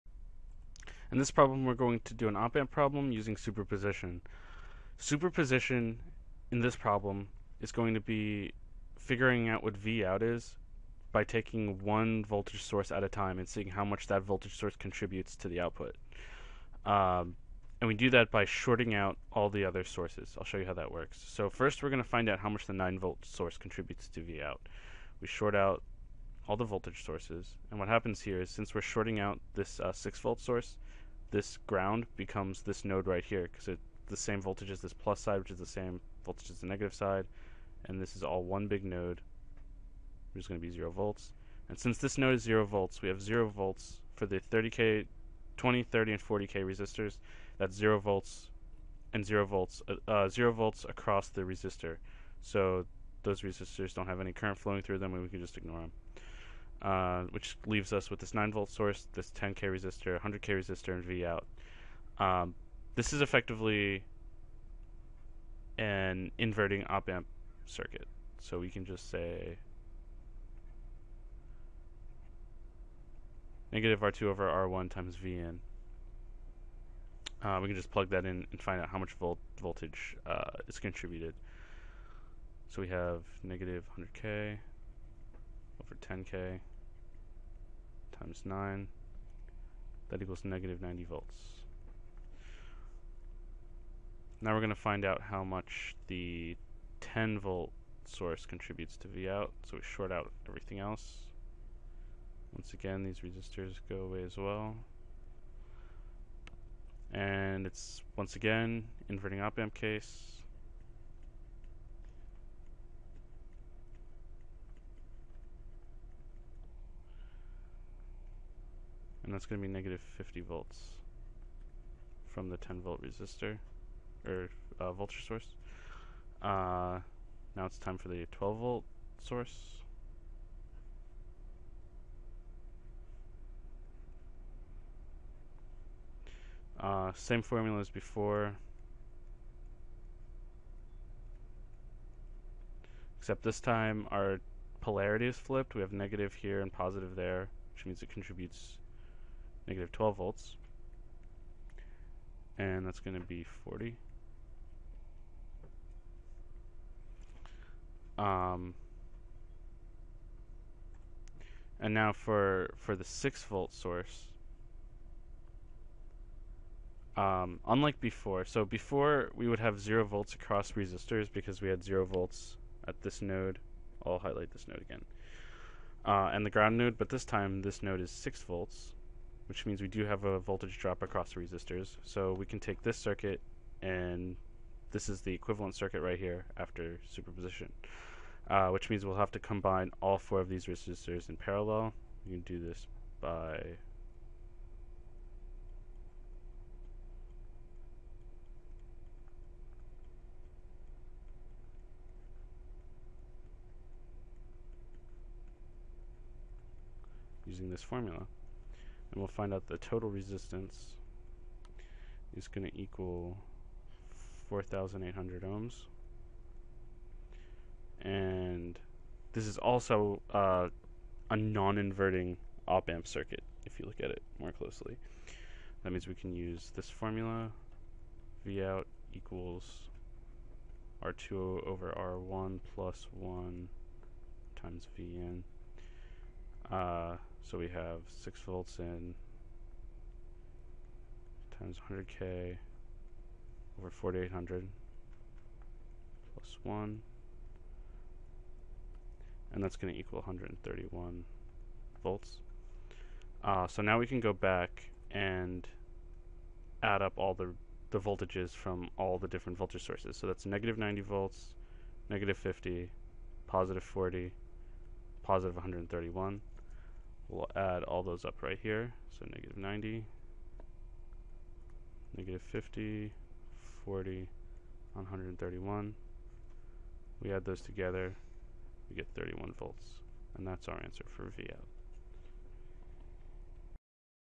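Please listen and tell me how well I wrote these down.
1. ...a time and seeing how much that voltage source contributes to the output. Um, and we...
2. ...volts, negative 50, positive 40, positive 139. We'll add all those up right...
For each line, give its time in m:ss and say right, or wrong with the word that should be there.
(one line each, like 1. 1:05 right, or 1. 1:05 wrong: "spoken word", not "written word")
1. 0:13 right
2. 4:21 wrong: "131", not "139".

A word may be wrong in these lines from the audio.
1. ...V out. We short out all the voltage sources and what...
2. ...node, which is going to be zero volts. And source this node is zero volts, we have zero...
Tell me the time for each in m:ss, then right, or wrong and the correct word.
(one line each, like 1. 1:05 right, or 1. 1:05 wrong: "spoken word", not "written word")
1. 0:24 right
2. 0:38 wrong: "since", not "source".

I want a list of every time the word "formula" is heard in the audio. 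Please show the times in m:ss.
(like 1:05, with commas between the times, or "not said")
2:17, 3:27, 3:46.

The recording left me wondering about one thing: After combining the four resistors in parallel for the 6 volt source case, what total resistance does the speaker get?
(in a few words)
4,800 ohms.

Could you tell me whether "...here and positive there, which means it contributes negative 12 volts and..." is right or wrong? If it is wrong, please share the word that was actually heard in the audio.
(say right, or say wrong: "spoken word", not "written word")
right.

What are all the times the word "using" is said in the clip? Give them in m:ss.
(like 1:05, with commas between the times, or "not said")
0:03, 3:27.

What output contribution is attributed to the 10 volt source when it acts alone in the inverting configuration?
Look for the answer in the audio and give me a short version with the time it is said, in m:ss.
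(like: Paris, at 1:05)
-50 volts, at 1:59.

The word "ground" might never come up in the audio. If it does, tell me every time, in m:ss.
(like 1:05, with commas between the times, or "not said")
0:31, 2:56.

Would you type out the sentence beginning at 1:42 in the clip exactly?
Once again, these resistors go away as well.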